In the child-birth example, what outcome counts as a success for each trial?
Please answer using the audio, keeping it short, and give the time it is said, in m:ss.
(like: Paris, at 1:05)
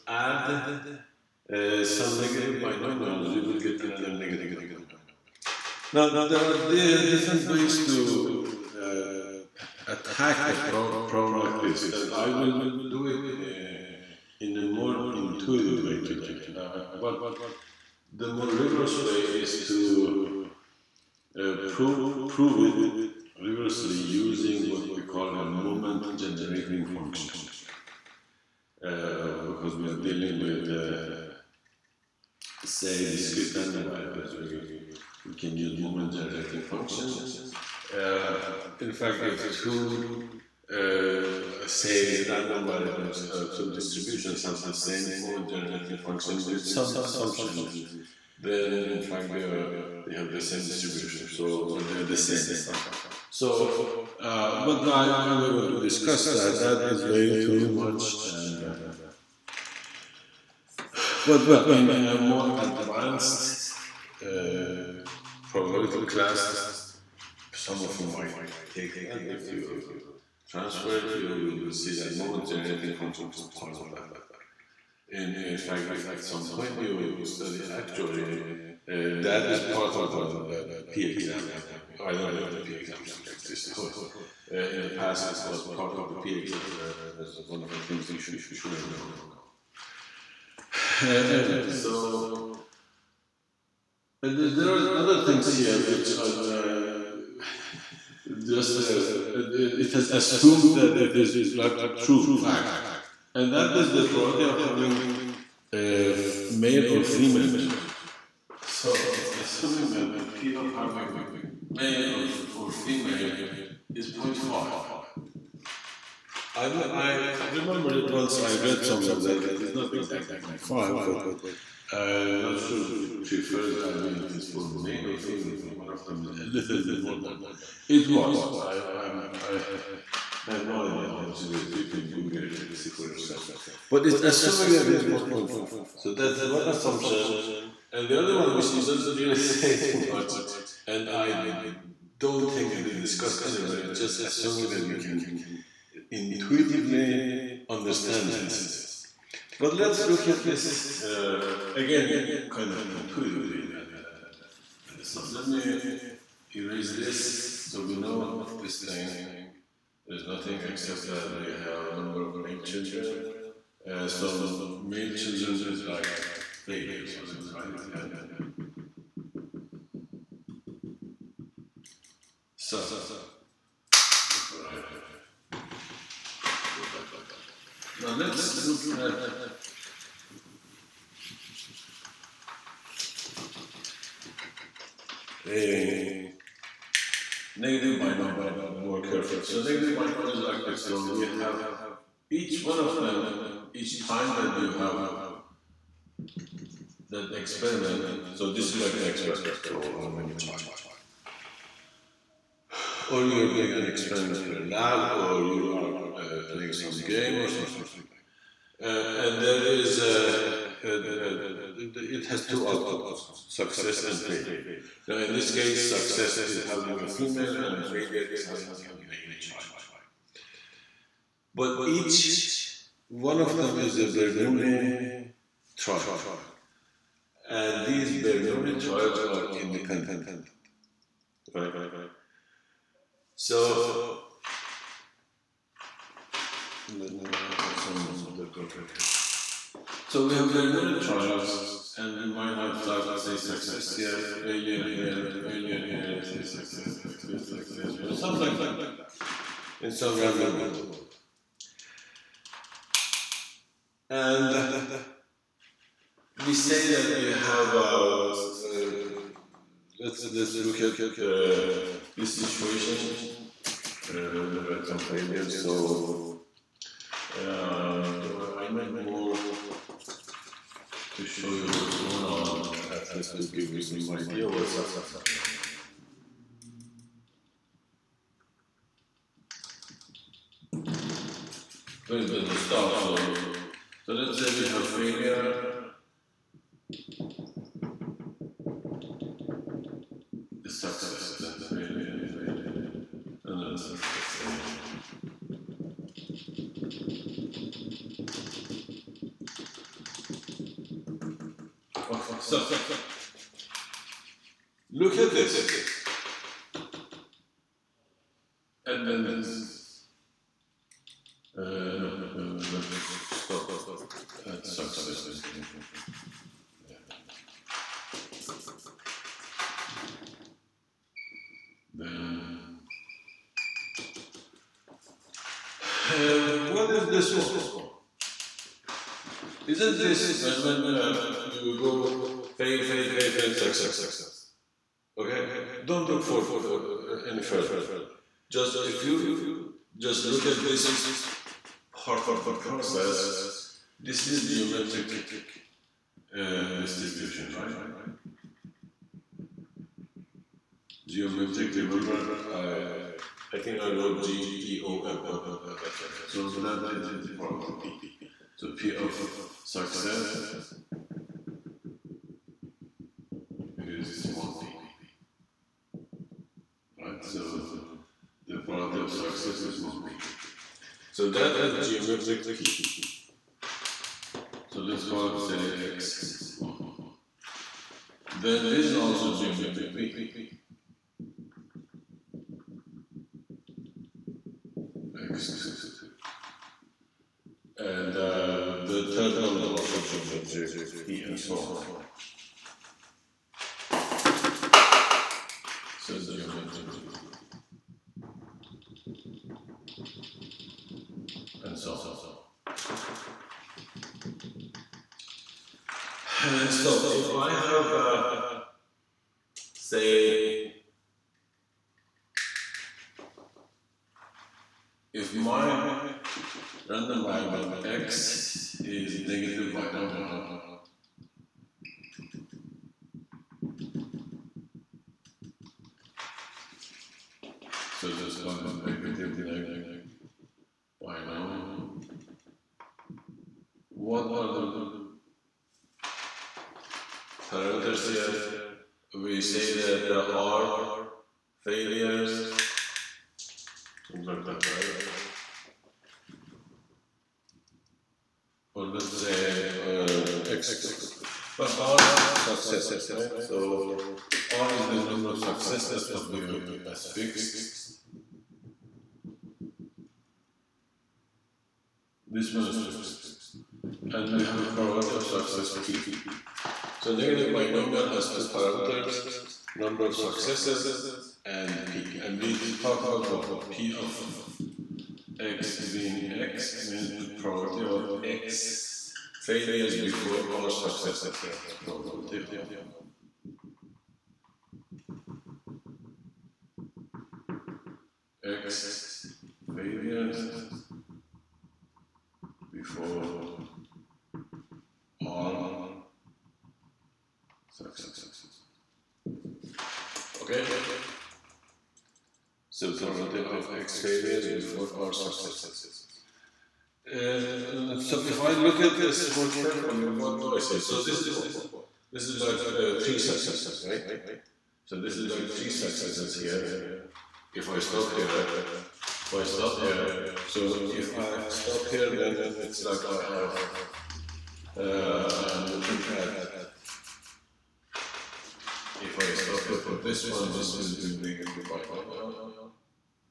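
having a female, at 3:36.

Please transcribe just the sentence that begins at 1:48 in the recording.
So it's assuming that P of having male or, or female is 0.5.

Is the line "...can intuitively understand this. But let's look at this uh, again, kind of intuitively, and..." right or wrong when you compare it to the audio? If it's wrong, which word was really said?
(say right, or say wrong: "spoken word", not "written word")
right.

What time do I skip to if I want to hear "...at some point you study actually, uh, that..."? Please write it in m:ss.
1:16.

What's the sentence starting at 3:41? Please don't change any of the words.
But each one of them is a Bernoulli trial and these Bernoulli trials are independent.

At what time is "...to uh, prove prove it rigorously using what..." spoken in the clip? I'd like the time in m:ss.
0:19.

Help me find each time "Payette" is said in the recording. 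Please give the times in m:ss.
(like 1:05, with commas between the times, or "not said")
not said.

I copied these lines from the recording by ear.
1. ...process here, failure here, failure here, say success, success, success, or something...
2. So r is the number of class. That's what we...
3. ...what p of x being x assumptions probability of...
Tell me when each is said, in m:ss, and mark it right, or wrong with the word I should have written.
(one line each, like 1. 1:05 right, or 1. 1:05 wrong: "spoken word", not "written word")
1. 4:03 wrong: "success", not "process"
2. 7:33 wrong: "success", not "class"
3. 7:53 wrong: "means", not "assumptions".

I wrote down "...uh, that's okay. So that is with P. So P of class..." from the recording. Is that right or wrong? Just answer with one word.
wrong.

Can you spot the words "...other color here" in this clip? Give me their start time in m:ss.
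3:58.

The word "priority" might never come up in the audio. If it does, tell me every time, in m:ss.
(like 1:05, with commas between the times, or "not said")
1:44.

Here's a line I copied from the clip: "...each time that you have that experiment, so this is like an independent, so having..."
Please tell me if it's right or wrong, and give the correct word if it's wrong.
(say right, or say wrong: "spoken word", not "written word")
wrong: "experiment", not "independent".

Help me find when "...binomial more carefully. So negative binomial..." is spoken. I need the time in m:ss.
3:07.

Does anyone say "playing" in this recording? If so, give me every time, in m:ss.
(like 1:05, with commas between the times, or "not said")
3:26.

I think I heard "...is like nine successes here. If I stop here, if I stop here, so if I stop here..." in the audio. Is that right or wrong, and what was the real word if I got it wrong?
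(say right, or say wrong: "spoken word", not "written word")
wrong: "three", not "nine".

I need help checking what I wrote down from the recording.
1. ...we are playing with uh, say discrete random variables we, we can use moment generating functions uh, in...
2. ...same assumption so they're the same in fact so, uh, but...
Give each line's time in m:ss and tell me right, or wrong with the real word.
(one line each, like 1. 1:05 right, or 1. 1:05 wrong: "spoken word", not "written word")
1. 0:29 wrong: "dealing", not "playing"
2. 0:50 wrong: "distribution", not "assumption".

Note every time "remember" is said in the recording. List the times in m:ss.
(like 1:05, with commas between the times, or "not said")
1:57, 5:51.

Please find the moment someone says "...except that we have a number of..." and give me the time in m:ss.
2:40.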